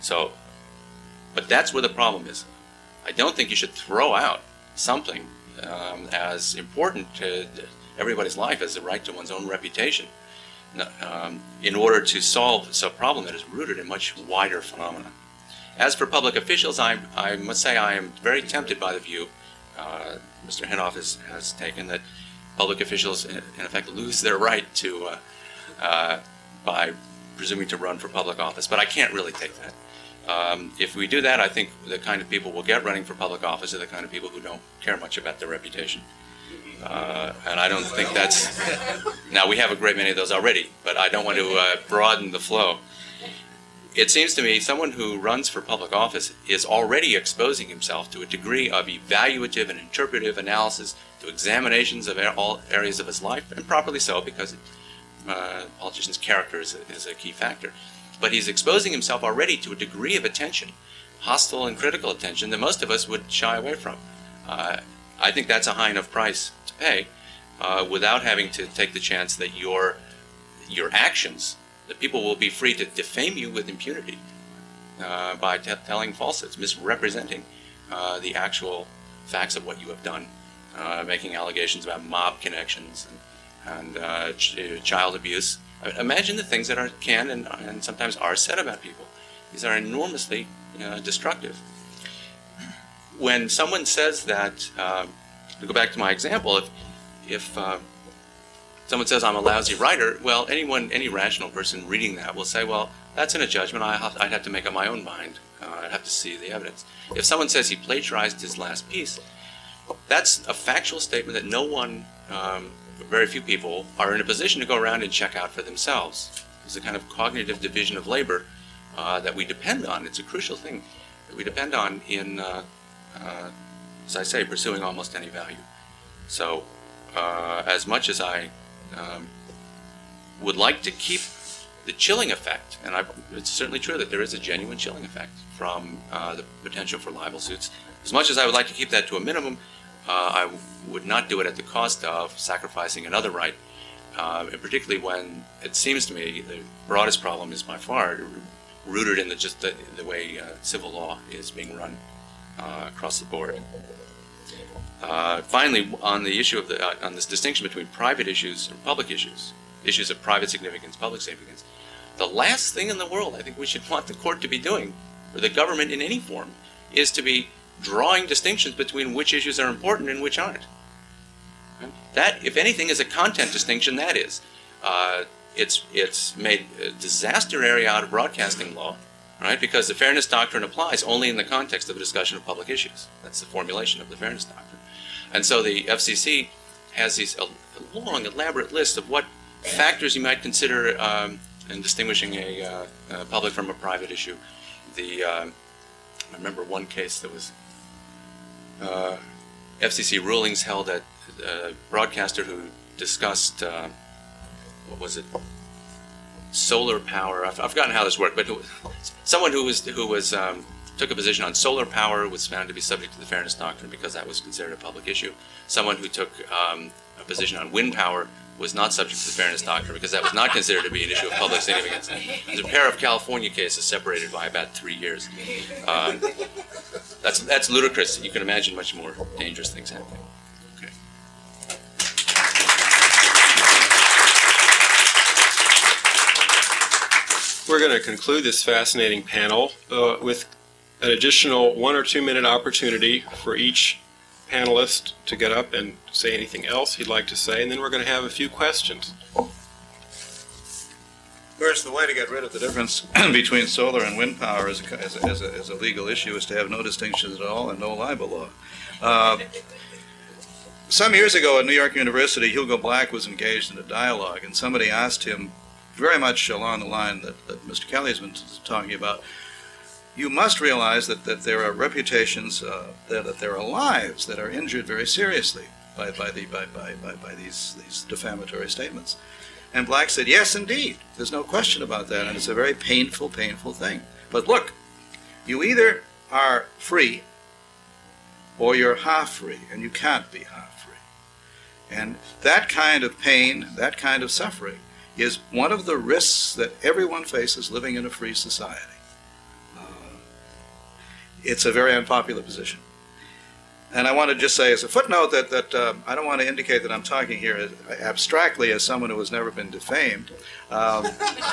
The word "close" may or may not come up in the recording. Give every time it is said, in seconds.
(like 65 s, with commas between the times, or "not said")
not said.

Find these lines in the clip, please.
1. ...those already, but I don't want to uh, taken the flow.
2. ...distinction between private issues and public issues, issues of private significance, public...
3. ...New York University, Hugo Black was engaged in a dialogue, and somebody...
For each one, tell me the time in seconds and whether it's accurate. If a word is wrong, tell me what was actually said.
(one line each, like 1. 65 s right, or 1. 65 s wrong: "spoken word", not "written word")
1. 40 s wrong: "broaden", not "taken"
2. 157 s right
3. 261 s right.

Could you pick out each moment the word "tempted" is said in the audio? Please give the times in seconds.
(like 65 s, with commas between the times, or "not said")
18 s.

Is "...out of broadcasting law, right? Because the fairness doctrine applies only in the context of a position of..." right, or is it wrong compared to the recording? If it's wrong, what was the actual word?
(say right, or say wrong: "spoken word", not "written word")
wrong: "discussion", not "position".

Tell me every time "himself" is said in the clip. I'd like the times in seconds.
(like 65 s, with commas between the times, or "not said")
47 s, 58 s.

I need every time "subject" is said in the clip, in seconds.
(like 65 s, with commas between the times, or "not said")
212 s, 218 s.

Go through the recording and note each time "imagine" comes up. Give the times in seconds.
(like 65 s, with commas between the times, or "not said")
85 s, 228 s.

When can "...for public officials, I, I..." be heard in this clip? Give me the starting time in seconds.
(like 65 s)
15 s.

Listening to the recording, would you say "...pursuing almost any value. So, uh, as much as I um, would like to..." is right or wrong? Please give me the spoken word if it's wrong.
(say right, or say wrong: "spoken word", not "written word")
right.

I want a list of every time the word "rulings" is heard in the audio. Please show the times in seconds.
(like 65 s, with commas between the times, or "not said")
200 s.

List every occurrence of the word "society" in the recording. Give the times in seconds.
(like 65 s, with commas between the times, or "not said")
298 s.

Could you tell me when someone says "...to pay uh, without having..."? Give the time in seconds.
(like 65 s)
66 s.